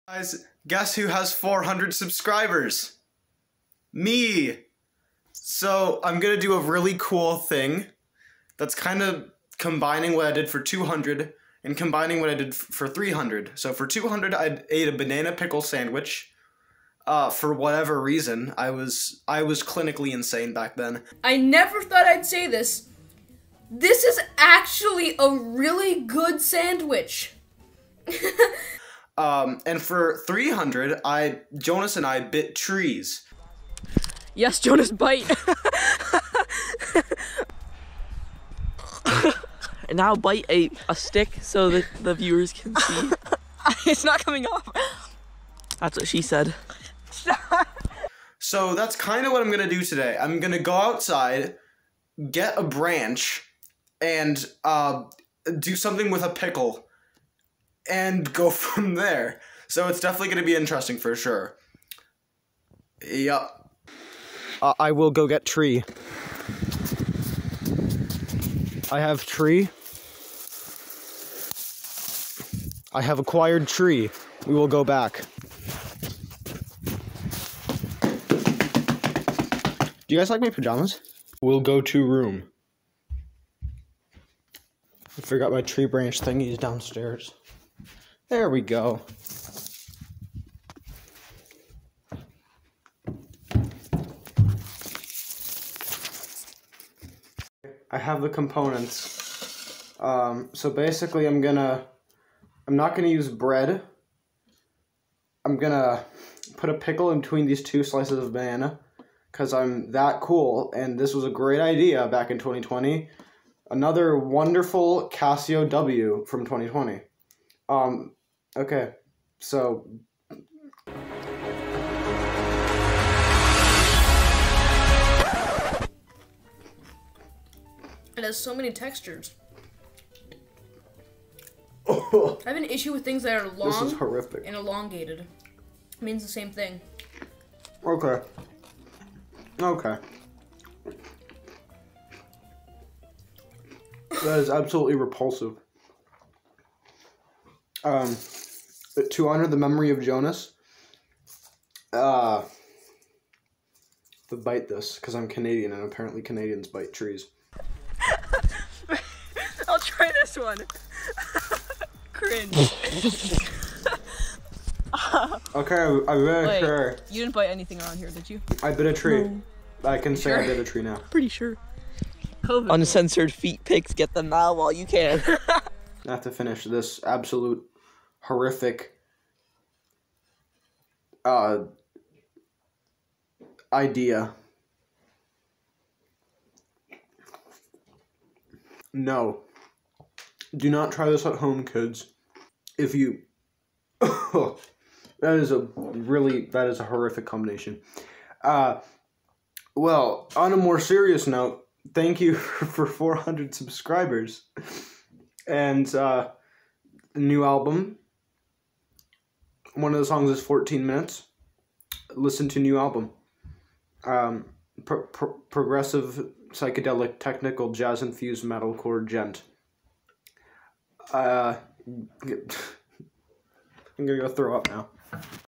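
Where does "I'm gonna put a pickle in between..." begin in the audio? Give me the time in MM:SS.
01:45.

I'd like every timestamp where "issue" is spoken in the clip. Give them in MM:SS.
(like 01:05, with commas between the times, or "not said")
02:12.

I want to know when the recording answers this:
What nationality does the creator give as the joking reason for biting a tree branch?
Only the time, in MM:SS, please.
02:35.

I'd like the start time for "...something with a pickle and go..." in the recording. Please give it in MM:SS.
00:55.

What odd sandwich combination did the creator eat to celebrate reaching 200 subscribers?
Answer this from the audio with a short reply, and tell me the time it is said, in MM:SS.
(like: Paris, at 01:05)
Banana pickle sandwich, at 00:14.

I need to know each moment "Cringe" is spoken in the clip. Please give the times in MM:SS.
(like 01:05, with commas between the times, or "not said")
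02:42.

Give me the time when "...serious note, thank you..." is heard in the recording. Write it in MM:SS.
03:20.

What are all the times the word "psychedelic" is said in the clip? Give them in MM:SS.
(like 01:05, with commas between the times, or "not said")
03:36.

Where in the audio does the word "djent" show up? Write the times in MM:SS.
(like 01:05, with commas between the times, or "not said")
03:39.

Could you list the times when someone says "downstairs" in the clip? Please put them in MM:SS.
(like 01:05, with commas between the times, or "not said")
01:26.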